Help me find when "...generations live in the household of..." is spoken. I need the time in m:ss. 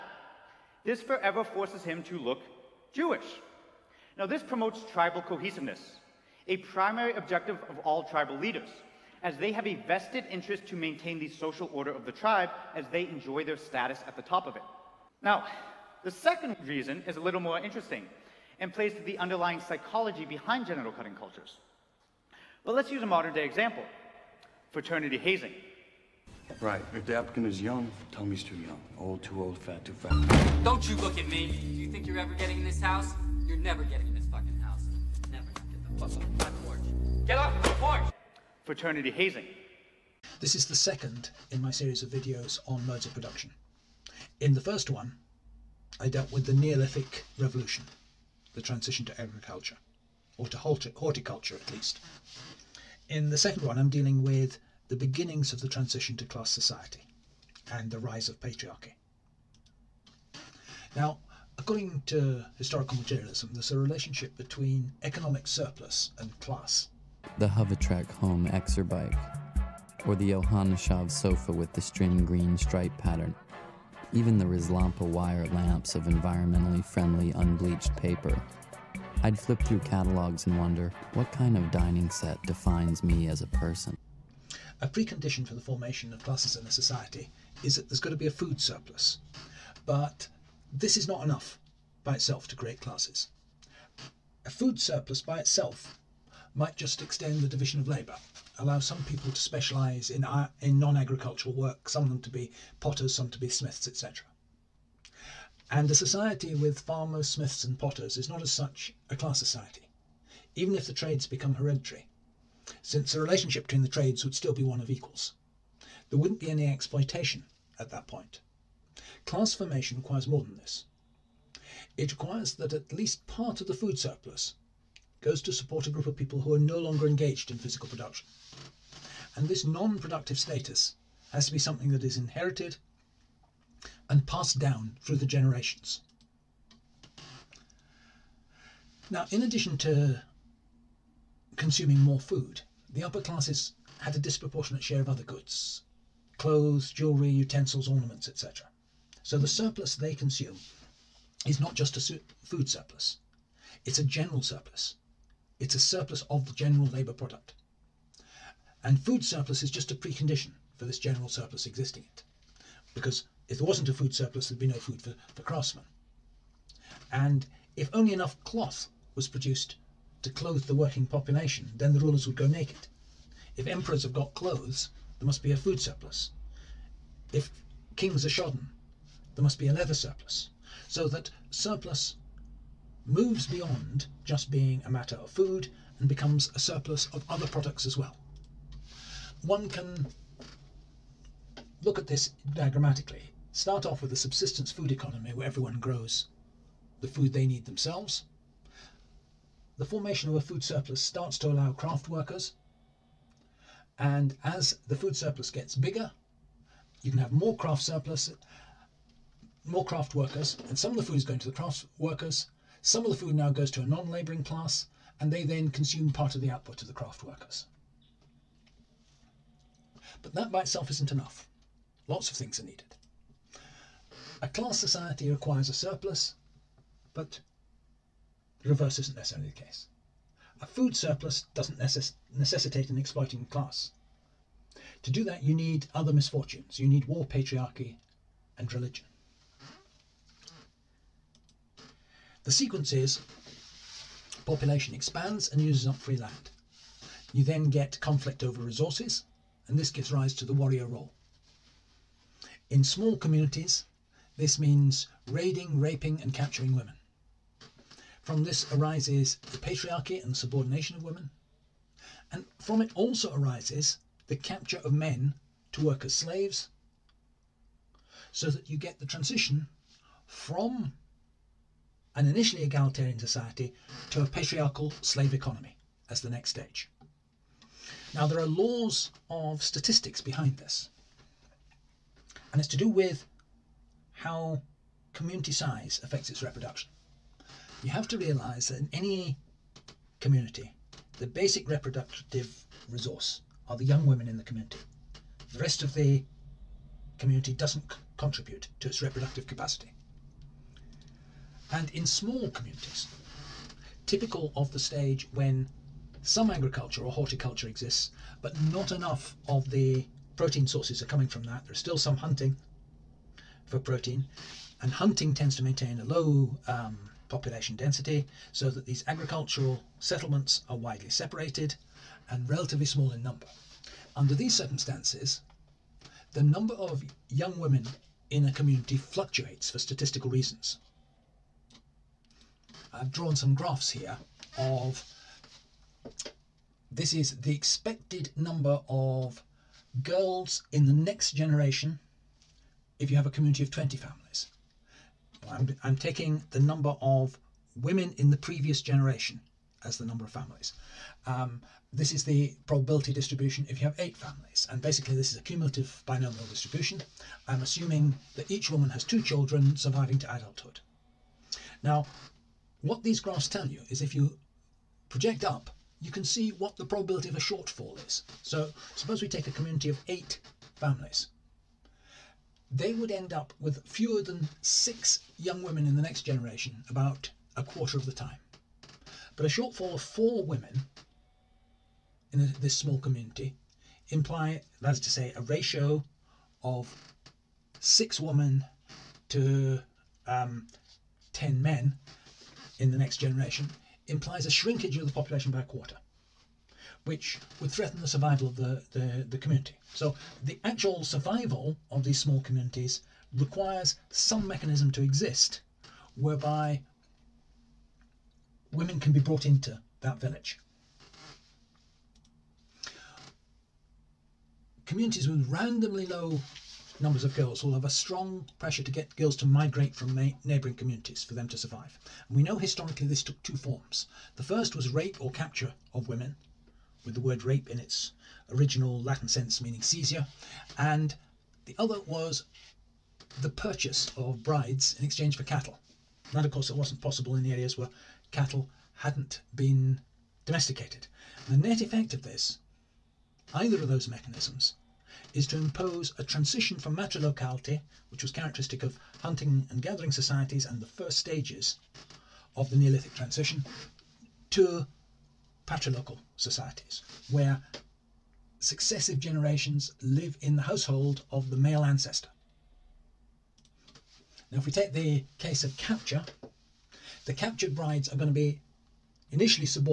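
7:39.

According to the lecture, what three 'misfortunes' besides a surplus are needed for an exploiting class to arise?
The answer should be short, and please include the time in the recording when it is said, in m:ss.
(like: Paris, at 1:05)
war, patriarchy, and religion, at 3:57.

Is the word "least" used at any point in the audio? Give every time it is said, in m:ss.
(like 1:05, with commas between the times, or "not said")
0:51, 2:02.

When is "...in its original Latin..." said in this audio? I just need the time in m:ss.
7:07.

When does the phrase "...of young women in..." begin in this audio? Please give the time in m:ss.
5:26.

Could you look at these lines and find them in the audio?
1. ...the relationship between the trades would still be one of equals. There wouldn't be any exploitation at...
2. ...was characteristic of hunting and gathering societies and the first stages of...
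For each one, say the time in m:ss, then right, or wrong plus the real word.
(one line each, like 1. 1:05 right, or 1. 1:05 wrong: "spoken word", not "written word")
1. 1:53 right
2. 7:28 right.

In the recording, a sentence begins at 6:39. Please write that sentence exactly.
So the actual survival of these small communities requires some mechanism to exist whereby women can be brought into that village.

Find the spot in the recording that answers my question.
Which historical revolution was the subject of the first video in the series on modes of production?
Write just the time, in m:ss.
0:46.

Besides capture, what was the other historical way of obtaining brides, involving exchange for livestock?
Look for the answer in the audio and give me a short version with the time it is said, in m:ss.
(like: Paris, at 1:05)
purchase of brides, at 7:13.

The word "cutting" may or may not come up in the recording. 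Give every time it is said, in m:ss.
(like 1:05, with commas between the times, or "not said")
0:20.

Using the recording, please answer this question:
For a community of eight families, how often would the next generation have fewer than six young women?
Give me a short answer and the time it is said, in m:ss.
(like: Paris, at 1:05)
a quarter of the time, at 6:16.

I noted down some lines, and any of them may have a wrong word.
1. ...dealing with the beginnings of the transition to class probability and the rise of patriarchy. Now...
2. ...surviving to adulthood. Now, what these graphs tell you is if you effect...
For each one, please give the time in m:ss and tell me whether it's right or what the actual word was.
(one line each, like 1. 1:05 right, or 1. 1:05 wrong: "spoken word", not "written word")
1. 0:53 wrong: "society", not "probability"
2. 5:59 wrong: "project", not "effect".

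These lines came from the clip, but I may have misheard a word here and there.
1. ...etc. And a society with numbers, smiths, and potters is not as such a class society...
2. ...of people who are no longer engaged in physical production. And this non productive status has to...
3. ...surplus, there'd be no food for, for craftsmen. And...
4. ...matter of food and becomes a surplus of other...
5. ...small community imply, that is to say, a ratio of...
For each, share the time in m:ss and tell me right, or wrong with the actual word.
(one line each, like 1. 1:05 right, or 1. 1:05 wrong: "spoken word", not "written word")
1. 1:43 wrong: "farmers", not "numbers"
2. 2:06 right
3. 2:44 right
4. 3:04 right
5. 6:22 right.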